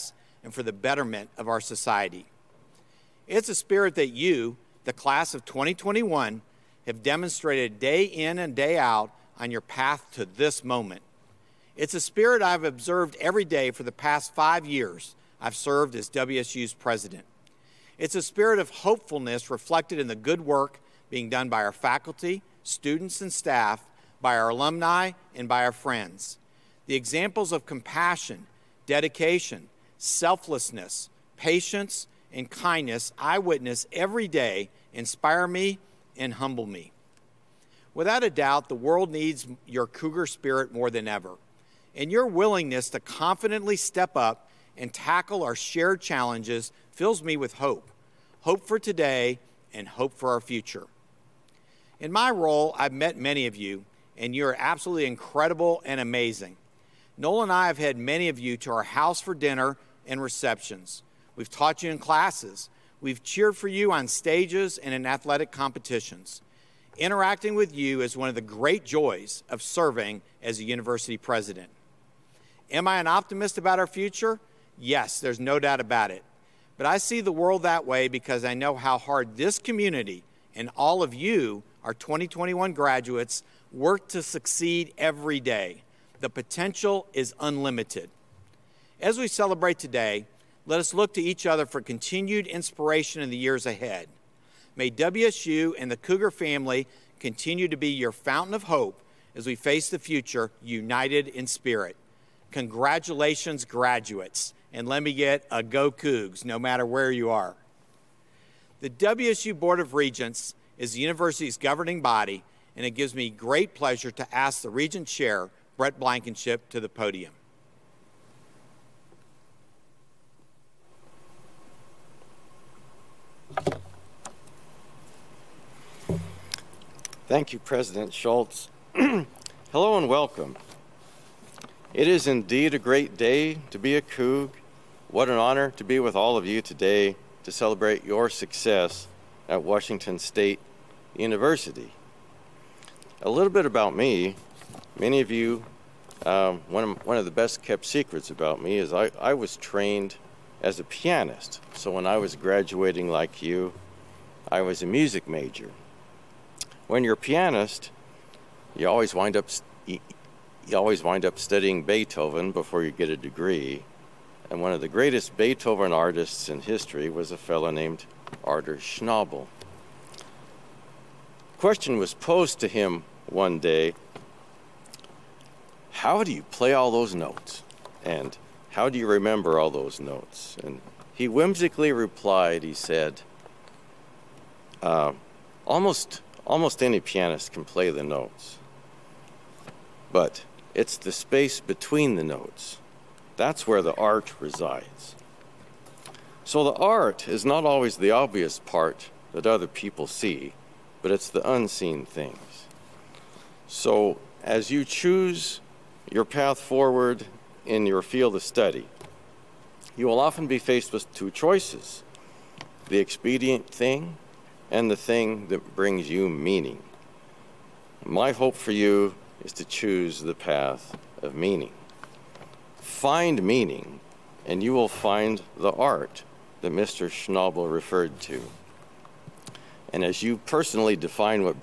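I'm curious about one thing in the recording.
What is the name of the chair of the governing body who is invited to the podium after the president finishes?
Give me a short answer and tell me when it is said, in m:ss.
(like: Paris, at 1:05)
Brett Blankenship, at 1:55.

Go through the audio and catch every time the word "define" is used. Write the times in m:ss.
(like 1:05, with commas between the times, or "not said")
3:50.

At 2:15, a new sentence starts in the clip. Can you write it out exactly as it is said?
What an honor to be with all of you today to celebrate your success at Washington State University.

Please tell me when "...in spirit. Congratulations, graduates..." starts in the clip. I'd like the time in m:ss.
1:41.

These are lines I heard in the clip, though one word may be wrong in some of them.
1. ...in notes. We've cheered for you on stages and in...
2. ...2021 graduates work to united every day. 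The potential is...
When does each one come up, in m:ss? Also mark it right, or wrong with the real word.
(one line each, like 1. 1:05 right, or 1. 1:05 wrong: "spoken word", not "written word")
1. 1:01 wrong: "classes", not "notes"
2. 1:21 wrong: "succeed", not "united".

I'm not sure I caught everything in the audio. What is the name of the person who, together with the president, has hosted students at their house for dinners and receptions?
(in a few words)
Noel.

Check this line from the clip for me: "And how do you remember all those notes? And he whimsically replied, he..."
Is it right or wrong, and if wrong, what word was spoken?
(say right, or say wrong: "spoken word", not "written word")
right.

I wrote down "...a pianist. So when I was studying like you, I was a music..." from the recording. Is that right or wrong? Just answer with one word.
wrong.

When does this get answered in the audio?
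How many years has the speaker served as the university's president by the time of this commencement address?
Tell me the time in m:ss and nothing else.
0:14.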